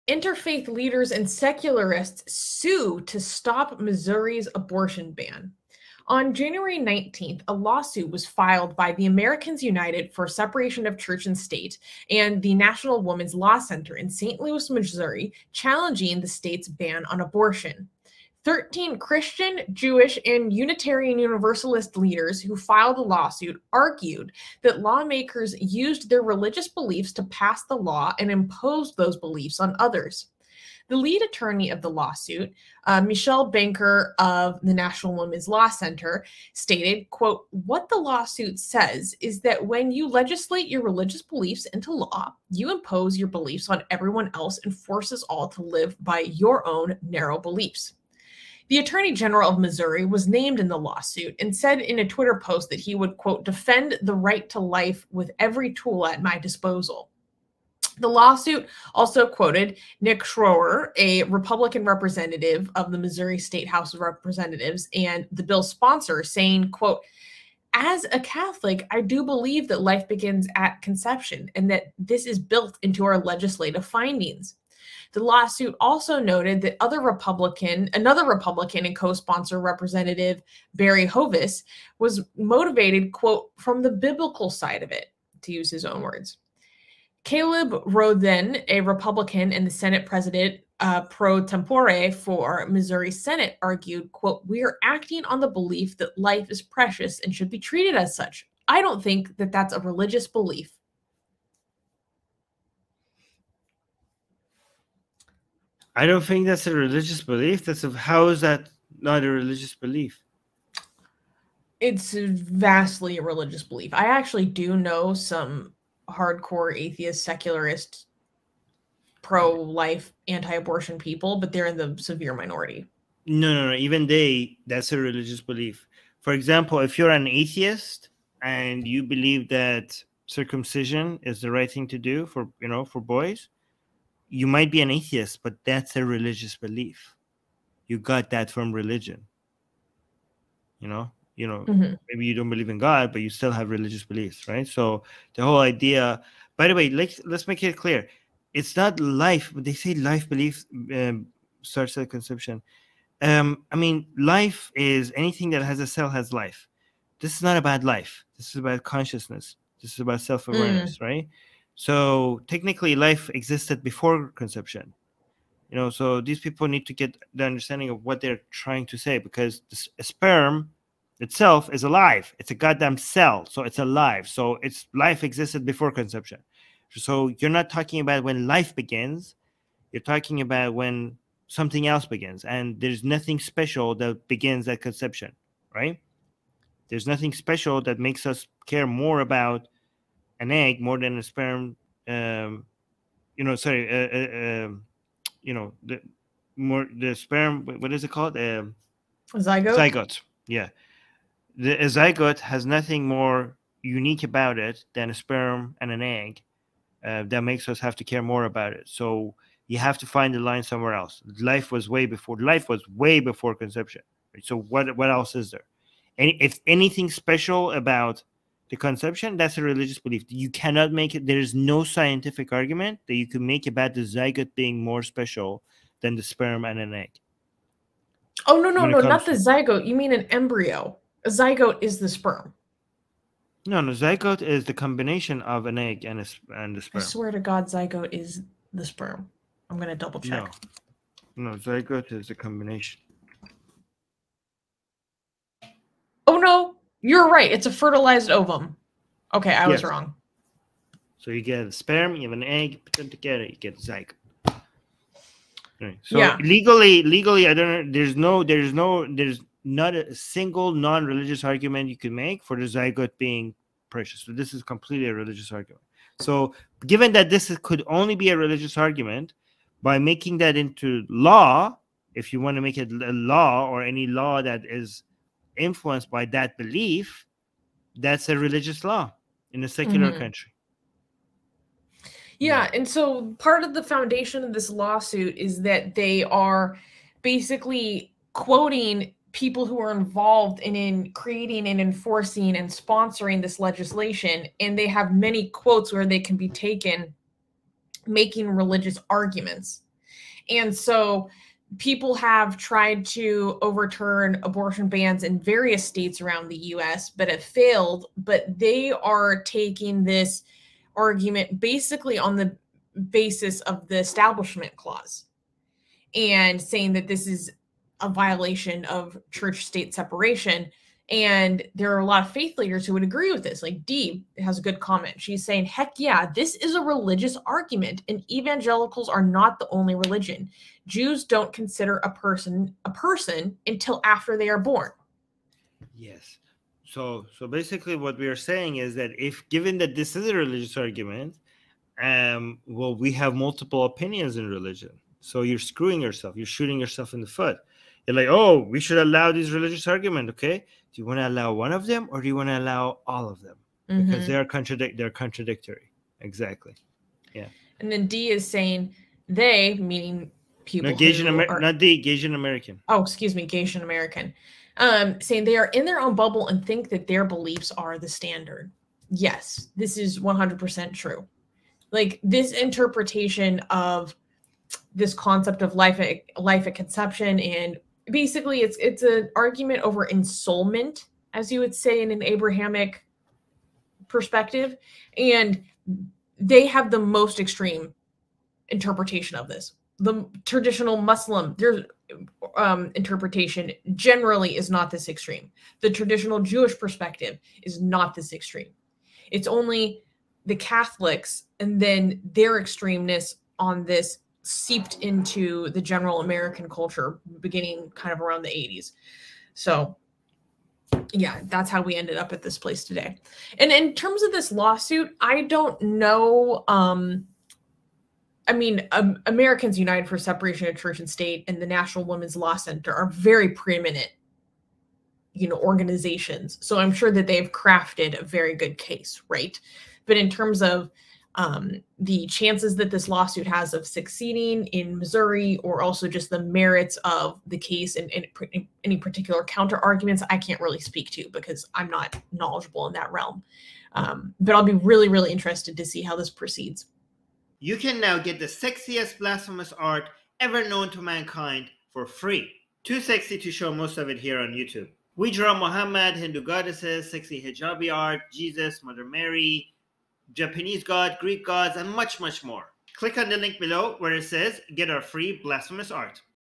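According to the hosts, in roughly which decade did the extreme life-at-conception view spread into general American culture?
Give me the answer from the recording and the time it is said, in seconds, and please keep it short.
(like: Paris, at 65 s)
the 80s, at 408 s.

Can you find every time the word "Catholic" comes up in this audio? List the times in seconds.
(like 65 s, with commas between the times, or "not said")
68 s, 400 s.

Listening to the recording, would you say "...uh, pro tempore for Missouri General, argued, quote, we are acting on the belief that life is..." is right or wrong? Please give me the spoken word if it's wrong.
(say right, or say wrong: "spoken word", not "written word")
wrong: "Senate", not "General".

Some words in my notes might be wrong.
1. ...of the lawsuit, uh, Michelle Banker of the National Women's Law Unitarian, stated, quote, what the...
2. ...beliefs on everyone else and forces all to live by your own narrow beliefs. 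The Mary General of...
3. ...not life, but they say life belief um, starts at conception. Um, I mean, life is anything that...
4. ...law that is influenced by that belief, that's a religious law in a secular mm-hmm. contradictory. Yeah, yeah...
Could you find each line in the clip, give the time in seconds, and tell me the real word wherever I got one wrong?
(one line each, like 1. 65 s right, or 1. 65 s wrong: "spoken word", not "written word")
1. 31 s wrong: "Center", not "Unitarian"
2. 43 s wrong: "Attorney", not "Mary"
3. 148 s right
4. 274 s wrong: "country", not "contradictory".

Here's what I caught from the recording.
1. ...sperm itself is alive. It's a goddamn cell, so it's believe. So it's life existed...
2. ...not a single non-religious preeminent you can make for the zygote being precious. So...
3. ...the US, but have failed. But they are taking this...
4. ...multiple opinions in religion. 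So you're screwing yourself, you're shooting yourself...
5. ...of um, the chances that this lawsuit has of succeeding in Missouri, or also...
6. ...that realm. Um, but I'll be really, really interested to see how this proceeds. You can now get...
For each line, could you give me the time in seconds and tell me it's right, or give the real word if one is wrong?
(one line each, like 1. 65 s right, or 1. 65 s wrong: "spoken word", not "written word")
1. 170 s wrong: "alive", not "believe"
2. 259 s wrong: "argument", not "preeminent"
3. 306 s right
4. 343 s right
5. 430 s right
6. 442 s right.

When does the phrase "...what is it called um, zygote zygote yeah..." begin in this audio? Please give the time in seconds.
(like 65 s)
197 s.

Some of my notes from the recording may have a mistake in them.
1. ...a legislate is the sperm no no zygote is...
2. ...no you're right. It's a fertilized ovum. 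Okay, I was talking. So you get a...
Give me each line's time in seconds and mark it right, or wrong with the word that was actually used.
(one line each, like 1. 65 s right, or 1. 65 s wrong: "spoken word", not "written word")
1. 231 s wrong: "zygote", not "legislate"
2. 246 s wrong: "wrong", not "talking".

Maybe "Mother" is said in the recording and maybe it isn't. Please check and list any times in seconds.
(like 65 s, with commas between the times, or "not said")
458 s.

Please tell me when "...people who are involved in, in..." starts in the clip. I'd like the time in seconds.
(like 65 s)
289 s.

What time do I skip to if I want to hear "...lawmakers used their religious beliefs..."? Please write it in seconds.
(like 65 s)
24 s.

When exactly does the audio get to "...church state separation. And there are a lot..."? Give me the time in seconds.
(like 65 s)
319 s.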